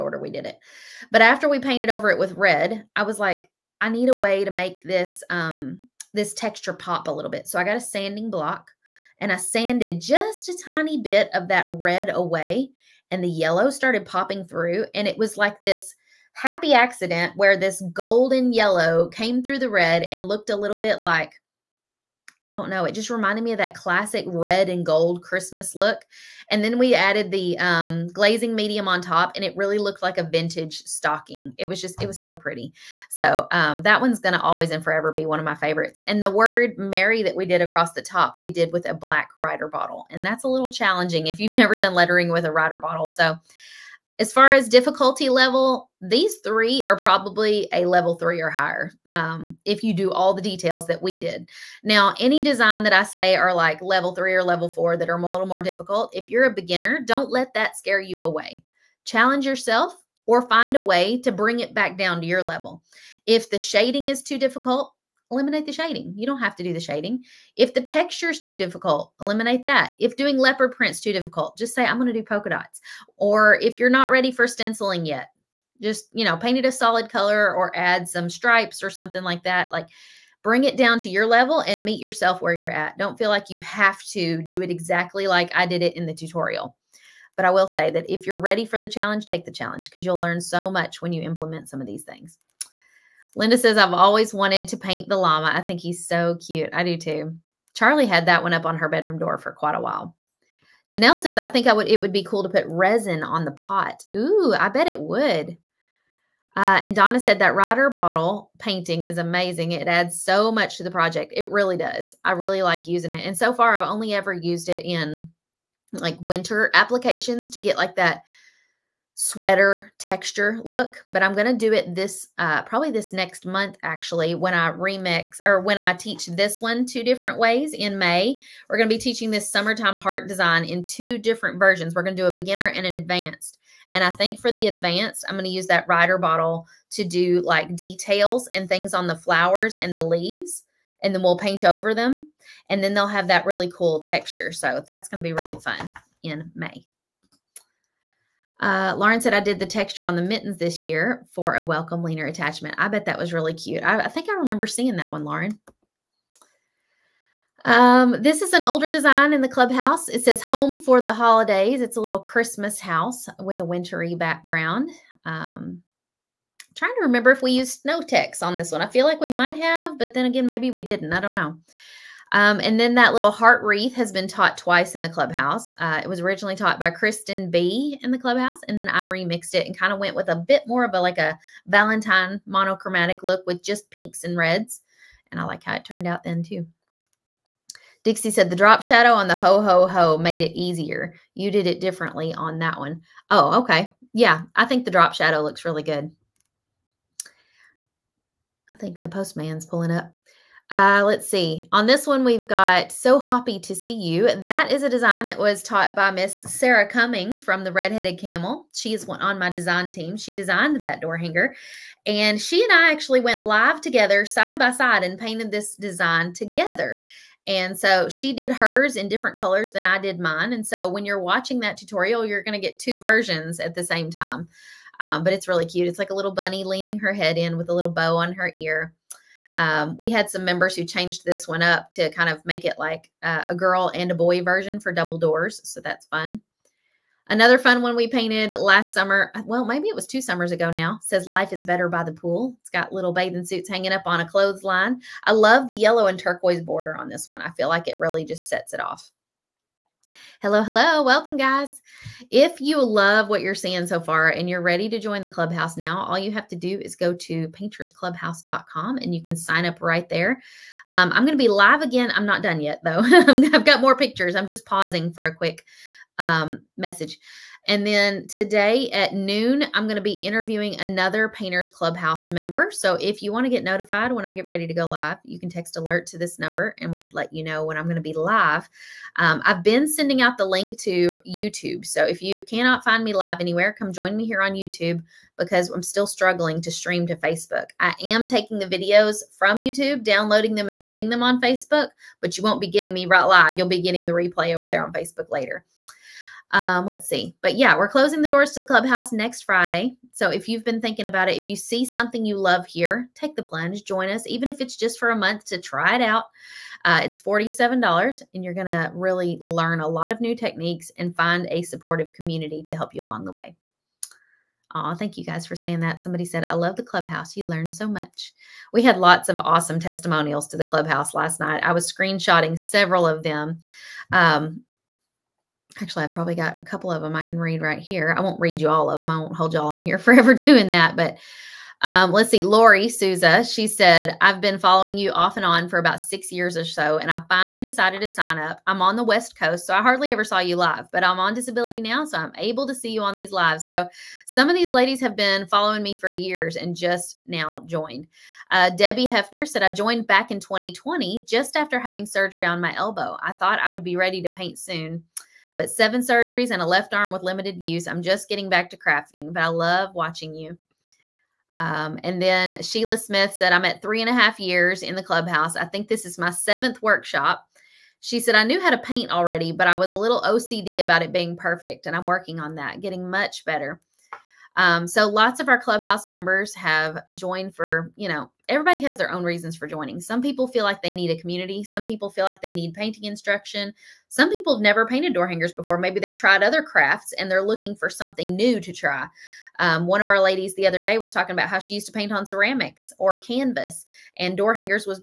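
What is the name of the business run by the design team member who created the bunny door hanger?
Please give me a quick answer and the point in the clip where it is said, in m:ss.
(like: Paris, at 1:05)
Redheaded Camel, at 3:27.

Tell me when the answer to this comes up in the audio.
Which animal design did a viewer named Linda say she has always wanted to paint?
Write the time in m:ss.
1:35.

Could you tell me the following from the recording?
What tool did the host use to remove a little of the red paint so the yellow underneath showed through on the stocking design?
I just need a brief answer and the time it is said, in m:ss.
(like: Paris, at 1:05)
sanding block, at 0:07.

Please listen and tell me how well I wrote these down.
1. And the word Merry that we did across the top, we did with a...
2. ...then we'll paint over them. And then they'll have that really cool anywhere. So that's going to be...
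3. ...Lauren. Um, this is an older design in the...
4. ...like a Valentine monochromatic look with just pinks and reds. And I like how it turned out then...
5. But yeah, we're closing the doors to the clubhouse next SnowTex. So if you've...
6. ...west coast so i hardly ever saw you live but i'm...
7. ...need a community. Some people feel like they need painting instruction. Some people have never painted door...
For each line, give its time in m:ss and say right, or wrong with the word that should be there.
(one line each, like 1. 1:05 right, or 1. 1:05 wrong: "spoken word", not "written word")
1. 0:36 right
2. 2:21 wrong: "texture", not "anywhere"
3. 2:35 right
4. 3:01 right
5. 4:57 wrong: "Friday", not "SnowTex"
6. 5:39 right
7. 6:20 right.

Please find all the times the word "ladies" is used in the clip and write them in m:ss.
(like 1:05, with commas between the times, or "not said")
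5:44, 6:30.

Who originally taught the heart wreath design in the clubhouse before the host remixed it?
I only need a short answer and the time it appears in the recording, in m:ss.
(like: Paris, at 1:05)
Kristen B, at 2:56.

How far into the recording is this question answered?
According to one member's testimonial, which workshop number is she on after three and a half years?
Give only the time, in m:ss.
6:06.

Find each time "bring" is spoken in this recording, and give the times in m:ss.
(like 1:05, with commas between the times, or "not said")
1:01, 1:20.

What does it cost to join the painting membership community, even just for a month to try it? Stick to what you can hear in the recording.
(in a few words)
$47.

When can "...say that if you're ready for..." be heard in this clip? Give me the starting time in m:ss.
1:27.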